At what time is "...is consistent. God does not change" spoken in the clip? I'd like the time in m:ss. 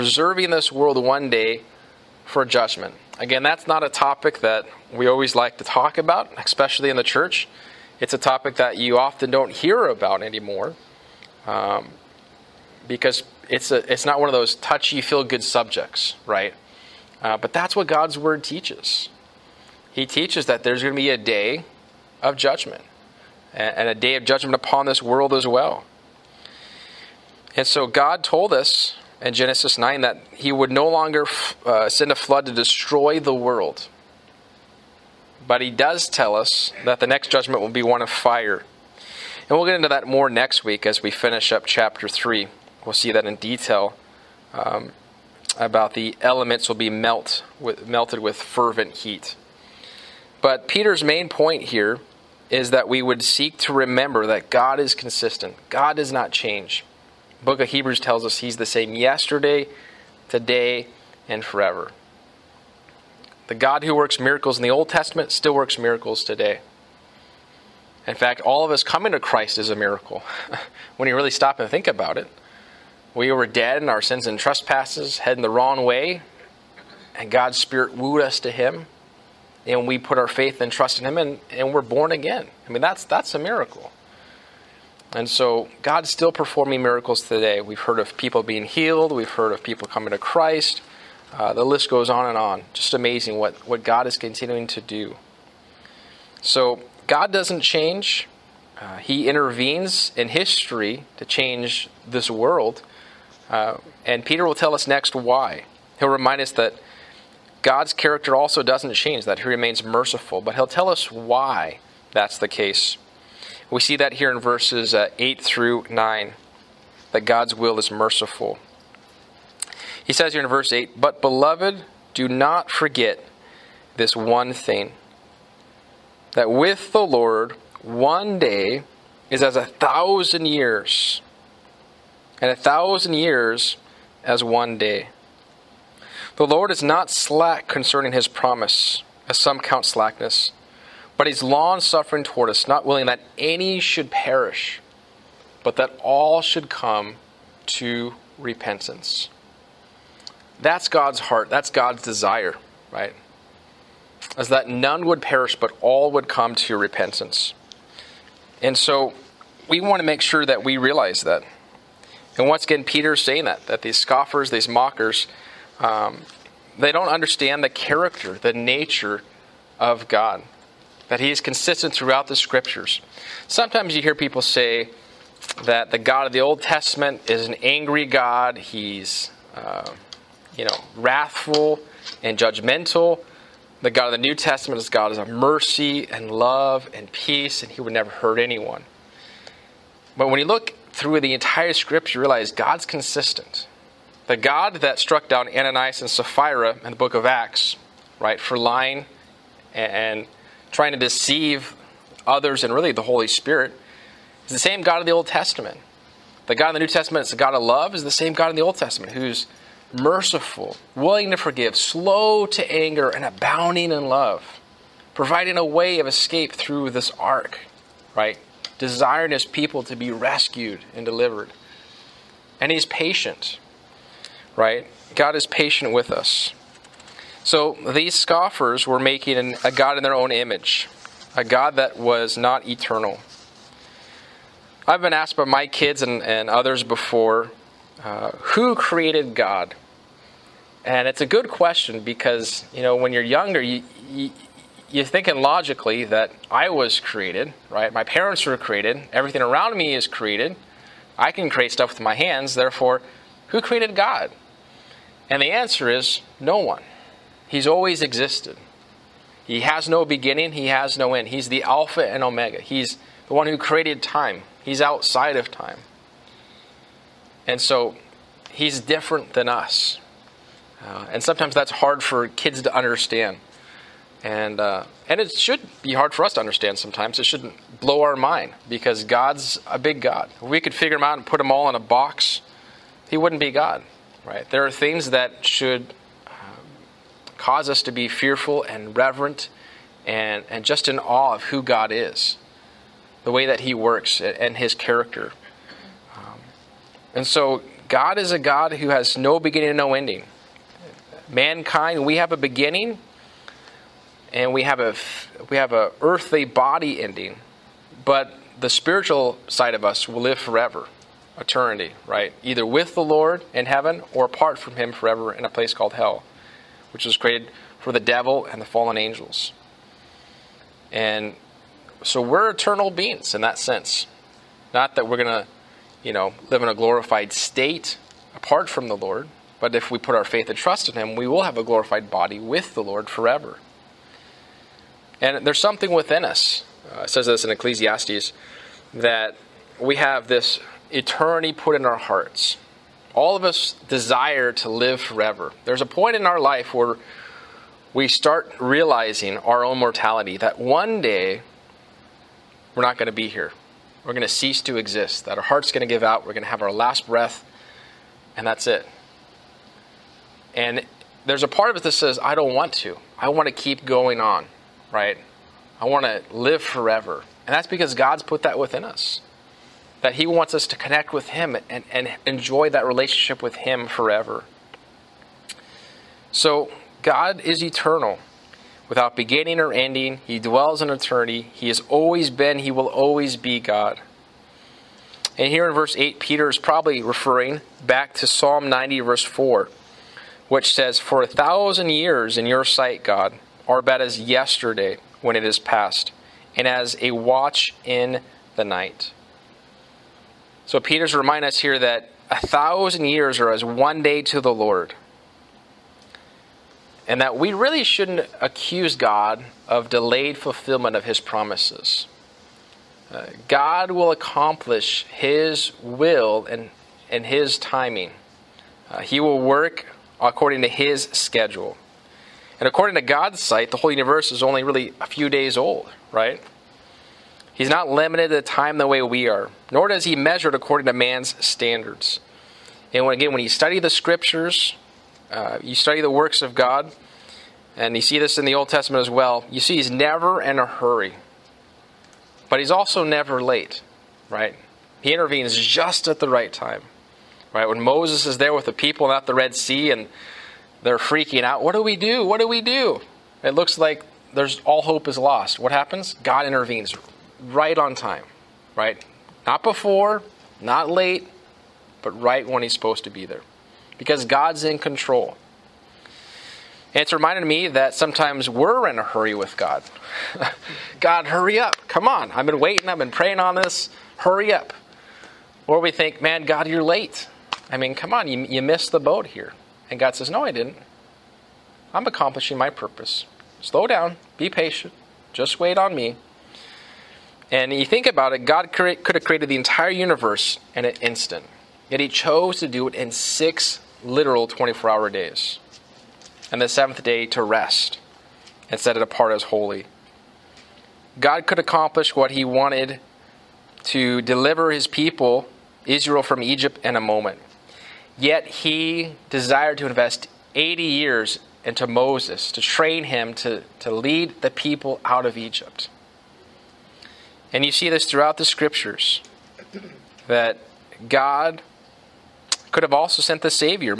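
0:54.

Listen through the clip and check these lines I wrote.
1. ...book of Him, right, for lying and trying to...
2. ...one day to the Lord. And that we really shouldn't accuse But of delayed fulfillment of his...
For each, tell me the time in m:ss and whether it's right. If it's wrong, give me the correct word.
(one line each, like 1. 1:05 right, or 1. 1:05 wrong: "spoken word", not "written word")
1. 3:16 wrong: "Acts", not "Him"
2. 6:43 wrong: "God", not "But".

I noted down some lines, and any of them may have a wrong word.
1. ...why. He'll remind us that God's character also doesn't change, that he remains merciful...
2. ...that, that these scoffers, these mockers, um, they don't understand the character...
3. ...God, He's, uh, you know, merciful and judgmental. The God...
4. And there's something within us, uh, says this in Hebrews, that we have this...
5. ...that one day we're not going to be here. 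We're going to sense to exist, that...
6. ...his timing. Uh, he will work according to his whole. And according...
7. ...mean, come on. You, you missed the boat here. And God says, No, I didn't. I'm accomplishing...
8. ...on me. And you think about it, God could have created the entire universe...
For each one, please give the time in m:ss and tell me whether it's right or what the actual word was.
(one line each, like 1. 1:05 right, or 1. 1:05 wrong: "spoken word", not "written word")
1. 1:45 right
2. 2:43 right
3. 2:58 wrong: "wrathful", not "merciful"
4. 5:35 wrong: "Ecclesiastes", not "Hebrews"
5. 5:50 wrong: "cease", not "sense"
6. 6:57 wrong: "schedule", not "whole"
7. 7:57 right
8. 8:05 right.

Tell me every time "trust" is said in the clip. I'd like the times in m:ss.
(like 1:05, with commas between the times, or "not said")
1:20, 5:30.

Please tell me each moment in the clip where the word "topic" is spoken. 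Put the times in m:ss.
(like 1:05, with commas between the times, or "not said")
0:03, 0:08.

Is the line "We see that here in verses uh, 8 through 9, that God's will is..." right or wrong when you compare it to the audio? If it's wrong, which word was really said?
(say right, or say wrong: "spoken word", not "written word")
right.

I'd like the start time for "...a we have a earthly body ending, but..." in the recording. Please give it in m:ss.
5:04.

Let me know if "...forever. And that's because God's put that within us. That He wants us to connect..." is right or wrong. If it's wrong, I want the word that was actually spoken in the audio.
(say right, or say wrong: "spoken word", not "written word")
right.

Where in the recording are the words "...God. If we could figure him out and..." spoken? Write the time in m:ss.
4:40.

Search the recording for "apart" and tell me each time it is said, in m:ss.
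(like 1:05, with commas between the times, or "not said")
5:14, 5:28, 8:19.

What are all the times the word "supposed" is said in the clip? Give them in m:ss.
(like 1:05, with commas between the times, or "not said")
7:42.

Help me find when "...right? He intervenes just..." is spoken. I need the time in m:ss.
7:24.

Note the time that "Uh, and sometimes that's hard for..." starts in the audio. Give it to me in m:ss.
4:30.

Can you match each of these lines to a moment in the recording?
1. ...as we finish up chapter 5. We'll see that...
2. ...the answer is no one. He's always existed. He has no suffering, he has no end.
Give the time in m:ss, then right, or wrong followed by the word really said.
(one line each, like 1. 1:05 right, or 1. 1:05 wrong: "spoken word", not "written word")
1. 0:40 wrong: "3", not "5"
2. 4:15 wrong: "beginning", not "suffering".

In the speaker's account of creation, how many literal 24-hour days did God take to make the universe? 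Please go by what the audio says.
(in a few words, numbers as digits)
6.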